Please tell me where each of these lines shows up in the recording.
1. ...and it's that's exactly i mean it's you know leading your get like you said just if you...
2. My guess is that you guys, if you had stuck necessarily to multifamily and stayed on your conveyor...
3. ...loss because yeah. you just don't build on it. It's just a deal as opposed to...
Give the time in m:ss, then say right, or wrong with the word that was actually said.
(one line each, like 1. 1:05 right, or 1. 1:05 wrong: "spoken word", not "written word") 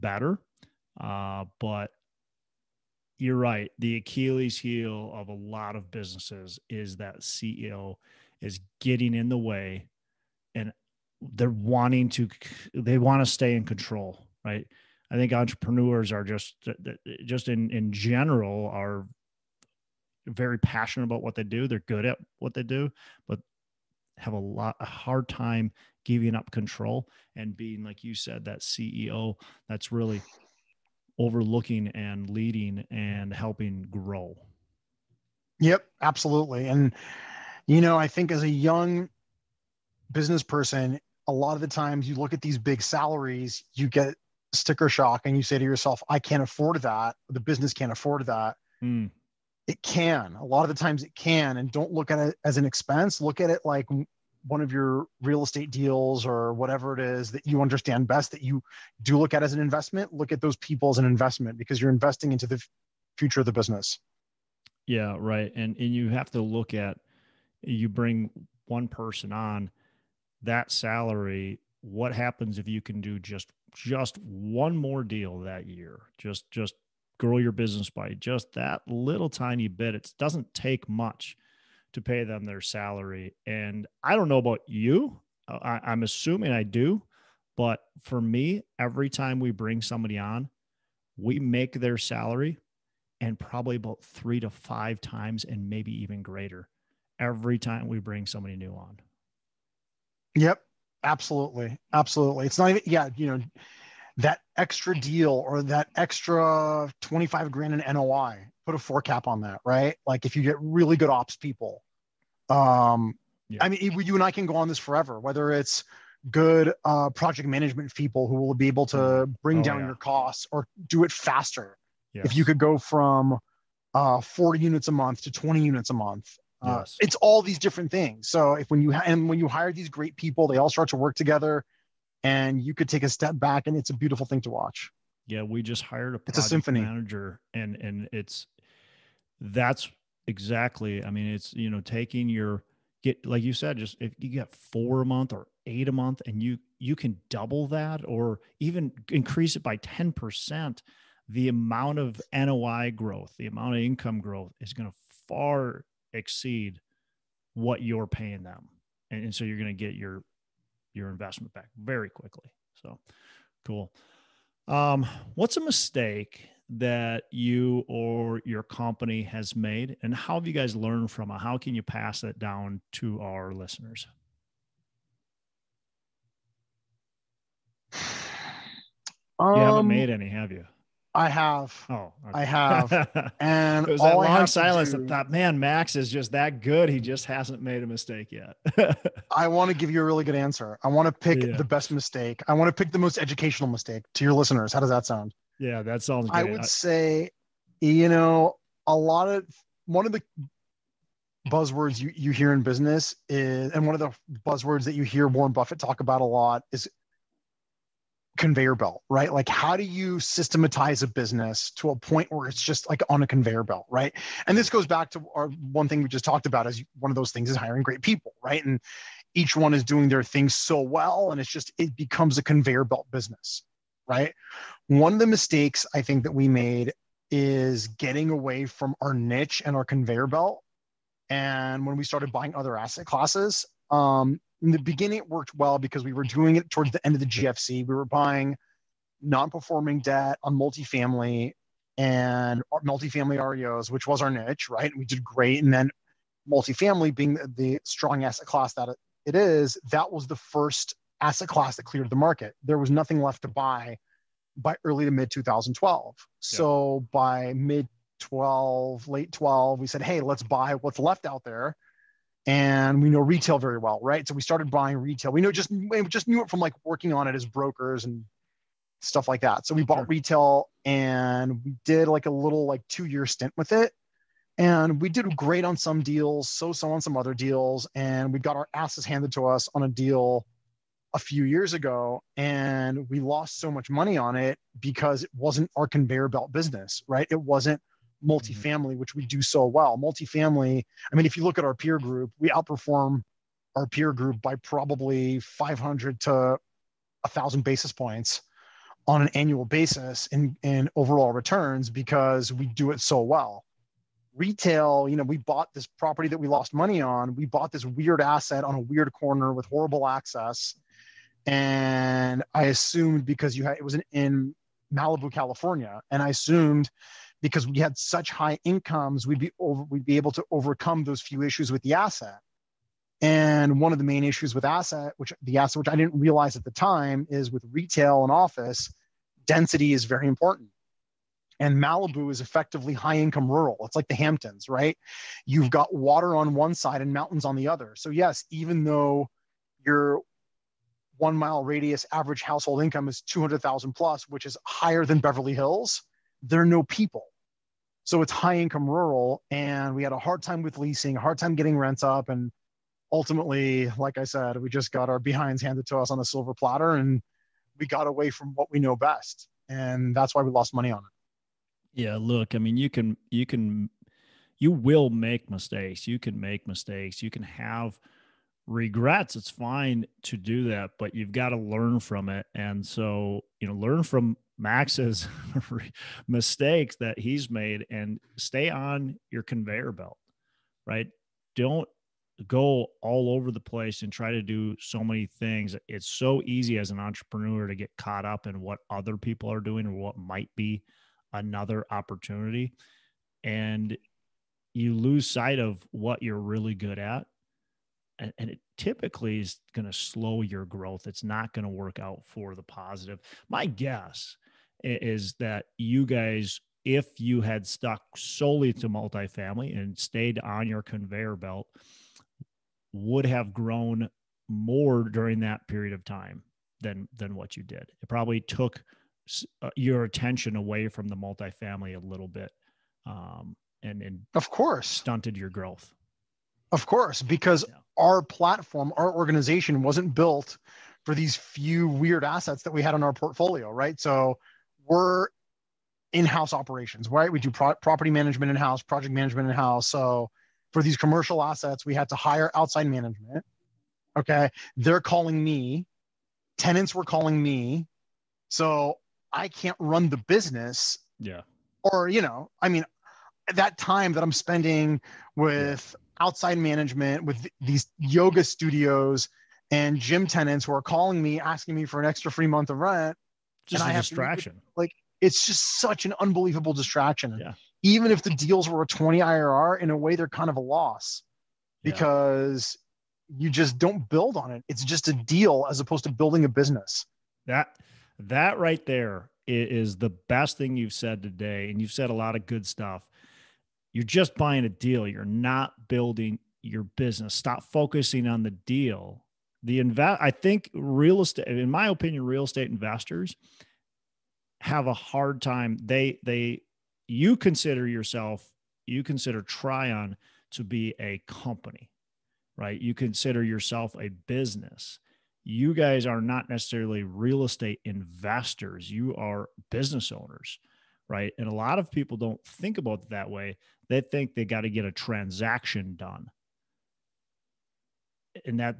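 1. 2:17 wrong: "taking", not "leading"
2. 6:43 wrong: "solely", not "necessarily"
3. 7:50 right.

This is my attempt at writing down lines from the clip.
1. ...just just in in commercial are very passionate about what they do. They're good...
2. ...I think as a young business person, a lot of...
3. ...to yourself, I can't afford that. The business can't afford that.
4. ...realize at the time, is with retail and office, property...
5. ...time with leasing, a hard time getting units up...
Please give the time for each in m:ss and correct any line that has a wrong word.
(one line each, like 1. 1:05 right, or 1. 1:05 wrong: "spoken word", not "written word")
1. 0:16 wrong: "general", not "commercial"
2. 0:37 right
3. 0:45 right
4. 5:26 wrong: "density", not "property"
5. 5:50 wrong: "rents", not "units".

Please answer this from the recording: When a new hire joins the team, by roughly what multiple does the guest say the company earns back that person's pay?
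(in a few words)
3 to 5 times.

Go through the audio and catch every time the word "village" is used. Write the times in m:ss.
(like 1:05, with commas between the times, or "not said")
not said.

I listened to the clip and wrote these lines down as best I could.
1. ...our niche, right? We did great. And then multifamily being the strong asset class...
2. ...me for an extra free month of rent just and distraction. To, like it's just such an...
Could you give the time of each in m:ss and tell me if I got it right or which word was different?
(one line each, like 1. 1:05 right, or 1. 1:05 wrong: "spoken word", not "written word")
1. 4:04 right
2. 7:41 right.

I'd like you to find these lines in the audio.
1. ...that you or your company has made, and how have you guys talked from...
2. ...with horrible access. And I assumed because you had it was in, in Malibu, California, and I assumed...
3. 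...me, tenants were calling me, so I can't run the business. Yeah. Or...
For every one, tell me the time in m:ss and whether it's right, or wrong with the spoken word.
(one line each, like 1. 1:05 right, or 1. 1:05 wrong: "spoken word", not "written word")
1. 2:46 wrong: "learned", not "talked"
2. 5:09 right
3. 7:25 right.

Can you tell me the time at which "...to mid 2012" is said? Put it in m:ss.
4:15.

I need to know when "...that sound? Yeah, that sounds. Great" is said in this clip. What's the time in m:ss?
3:14.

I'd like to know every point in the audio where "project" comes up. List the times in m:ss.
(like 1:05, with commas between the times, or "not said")
1:57, 7:18.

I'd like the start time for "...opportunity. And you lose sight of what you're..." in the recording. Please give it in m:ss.
6:31.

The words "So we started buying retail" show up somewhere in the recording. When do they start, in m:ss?
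4:24.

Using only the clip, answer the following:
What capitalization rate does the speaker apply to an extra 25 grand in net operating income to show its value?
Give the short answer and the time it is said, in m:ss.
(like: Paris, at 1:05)
4 cap, at 1:48.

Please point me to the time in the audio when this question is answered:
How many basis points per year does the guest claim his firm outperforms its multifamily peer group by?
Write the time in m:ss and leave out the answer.
4:55.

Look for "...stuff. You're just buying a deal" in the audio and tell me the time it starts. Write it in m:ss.
8:02.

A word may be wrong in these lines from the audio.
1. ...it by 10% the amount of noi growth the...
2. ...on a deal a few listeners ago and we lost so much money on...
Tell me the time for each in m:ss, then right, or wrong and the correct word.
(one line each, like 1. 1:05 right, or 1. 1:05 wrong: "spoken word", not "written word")
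1. 2:29 right
2. 4:39 wrong: "years", not "listeners".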